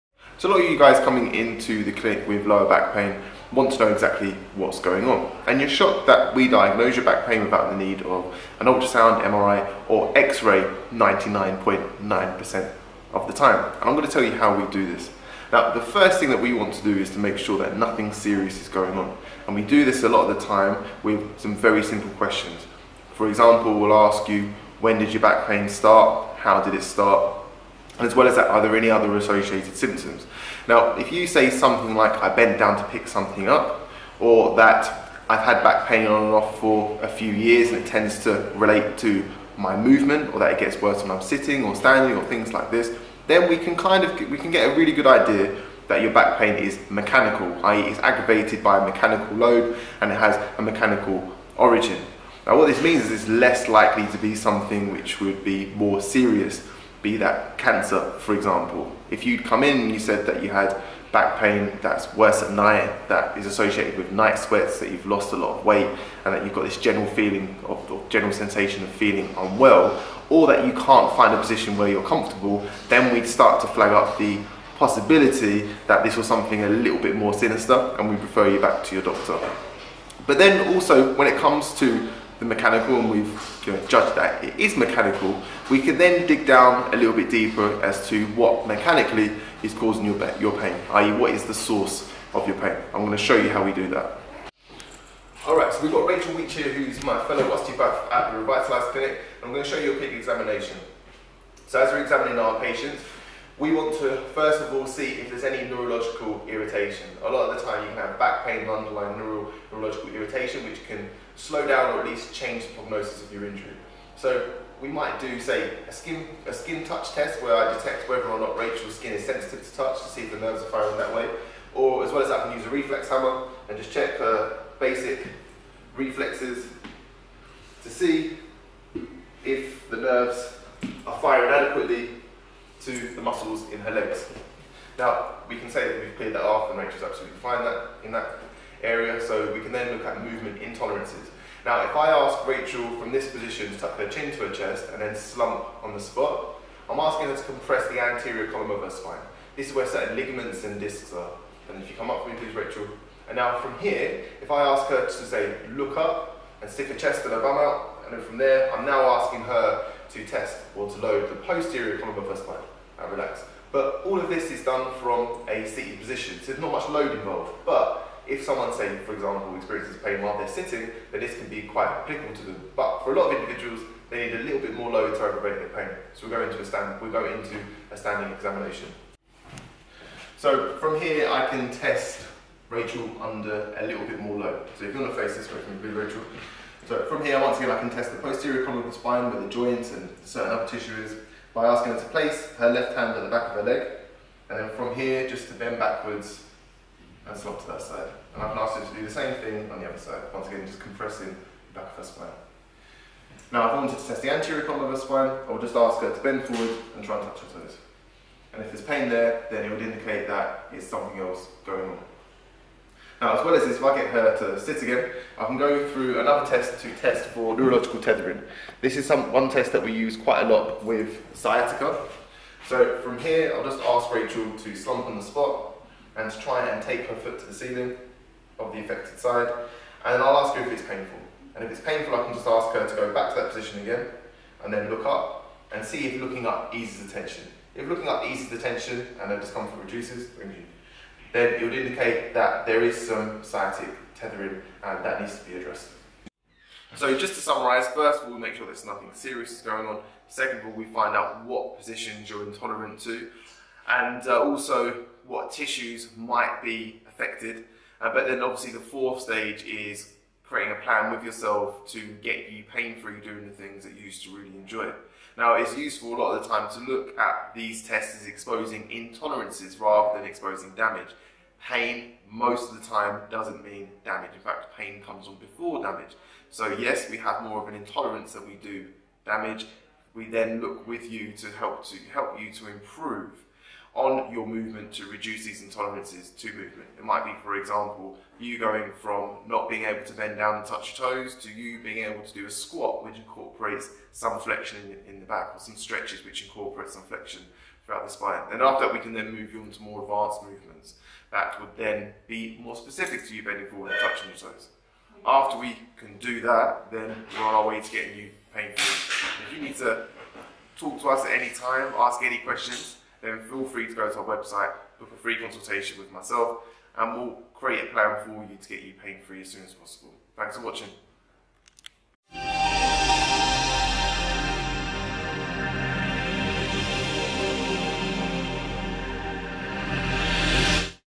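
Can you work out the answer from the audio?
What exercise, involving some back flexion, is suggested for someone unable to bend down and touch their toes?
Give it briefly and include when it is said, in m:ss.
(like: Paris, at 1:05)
squat, at 4:52.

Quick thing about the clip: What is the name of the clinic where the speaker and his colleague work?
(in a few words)
Revitalised Clinic.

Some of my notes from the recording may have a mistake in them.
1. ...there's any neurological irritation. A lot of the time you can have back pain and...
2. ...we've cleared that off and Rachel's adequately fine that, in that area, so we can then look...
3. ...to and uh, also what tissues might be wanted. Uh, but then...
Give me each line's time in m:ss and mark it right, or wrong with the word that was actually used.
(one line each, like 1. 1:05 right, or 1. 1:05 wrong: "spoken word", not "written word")
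1. 1:45 right
2. 2:16 wrong: "absolutely", not "adequately"
3. 4:13 wrong: "affected", not "wanted".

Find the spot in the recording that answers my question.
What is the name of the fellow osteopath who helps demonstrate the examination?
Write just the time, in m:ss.
1:36.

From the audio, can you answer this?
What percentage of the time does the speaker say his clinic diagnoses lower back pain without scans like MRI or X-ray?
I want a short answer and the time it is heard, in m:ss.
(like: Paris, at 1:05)
99.9%, at 0:10.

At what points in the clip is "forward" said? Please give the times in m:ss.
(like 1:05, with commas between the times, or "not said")
3:26, 5:03.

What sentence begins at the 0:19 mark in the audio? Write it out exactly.
And we do this a lot of the time with some very simple questions.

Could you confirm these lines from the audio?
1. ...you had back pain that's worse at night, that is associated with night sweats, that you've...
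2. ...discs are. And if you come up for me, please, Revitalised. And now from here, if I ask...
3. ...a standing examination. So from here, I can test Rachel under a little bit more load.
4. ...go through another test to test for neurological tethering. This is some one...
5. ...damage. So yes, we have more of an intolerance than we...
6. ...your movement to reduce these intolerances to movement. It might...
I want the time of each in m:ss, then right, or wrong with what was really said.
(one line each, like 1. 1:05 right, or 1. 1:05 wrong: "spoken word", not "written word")
1. 1:00 right
2. 2:30 wrong: "Rachel", not "Revitalised"
3. 2:57 right
4. 3:35 right
5. 4:35 right
6. 4:44 right.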